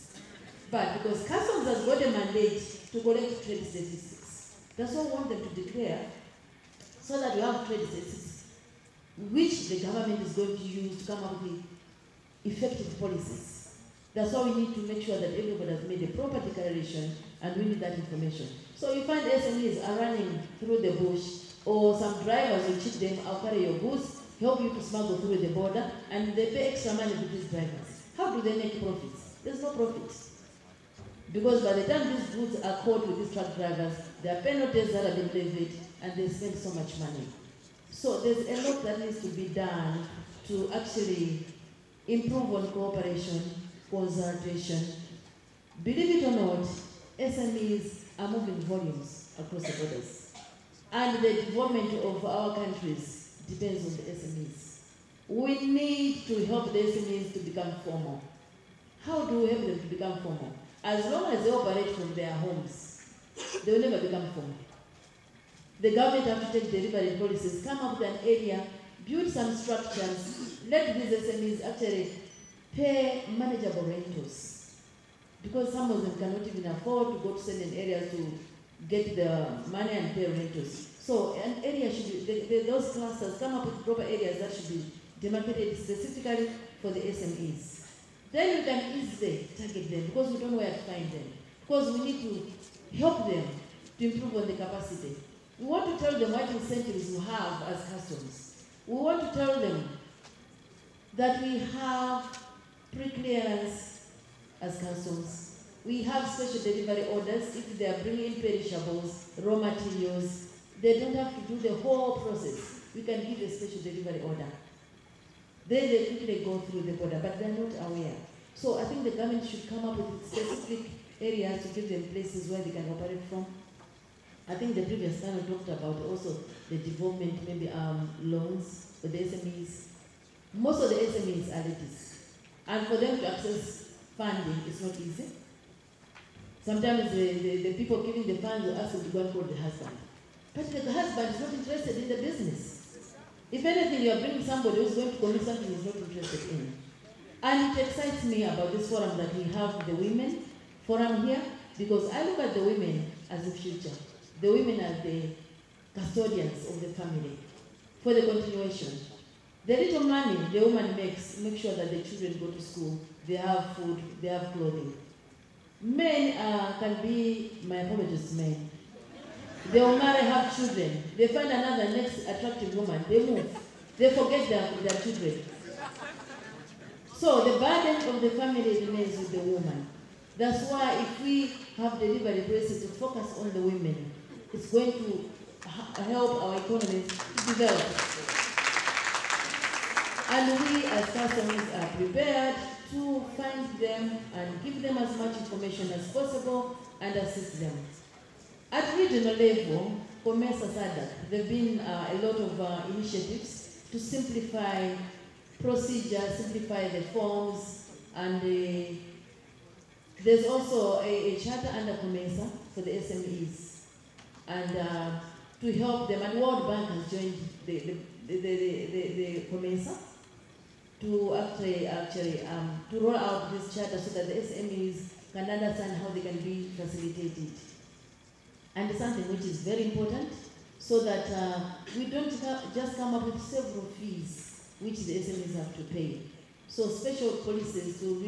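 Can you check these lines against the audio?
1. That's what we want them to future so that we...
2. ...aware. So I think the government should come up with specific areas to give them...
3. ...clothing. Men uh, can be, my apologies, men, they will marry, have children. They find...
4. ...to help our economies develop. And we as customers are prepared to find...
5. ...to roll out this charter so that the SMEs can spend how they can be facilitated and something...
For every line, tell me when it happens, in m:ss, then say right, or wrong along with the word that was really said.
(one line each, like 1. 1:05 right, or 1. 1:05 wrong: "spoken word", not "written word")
1. 0:04 wrong: "declare", not "future"
2. 1:57 right
3. 2:44 right
4. 3:04 right
5. 3:42 wrong: "understand", not "spend".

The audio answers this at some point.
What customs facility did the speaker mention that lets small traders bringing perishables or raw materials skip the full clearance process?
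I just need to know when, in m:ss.
1:53.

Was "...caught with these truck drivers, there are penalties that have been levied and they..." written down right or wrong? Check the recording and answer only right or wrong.
right.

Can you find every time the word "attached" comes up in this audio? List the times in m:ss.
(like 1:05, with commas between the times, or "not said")
not said.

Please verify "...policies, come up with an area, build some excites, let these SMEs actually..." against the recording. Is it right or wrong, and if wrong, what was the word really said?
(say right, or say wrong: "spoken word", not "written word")
wrong: "structures", not "excites".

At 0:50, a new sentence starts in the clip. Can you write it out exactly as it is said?
And the development of our countries depends on the SMEs.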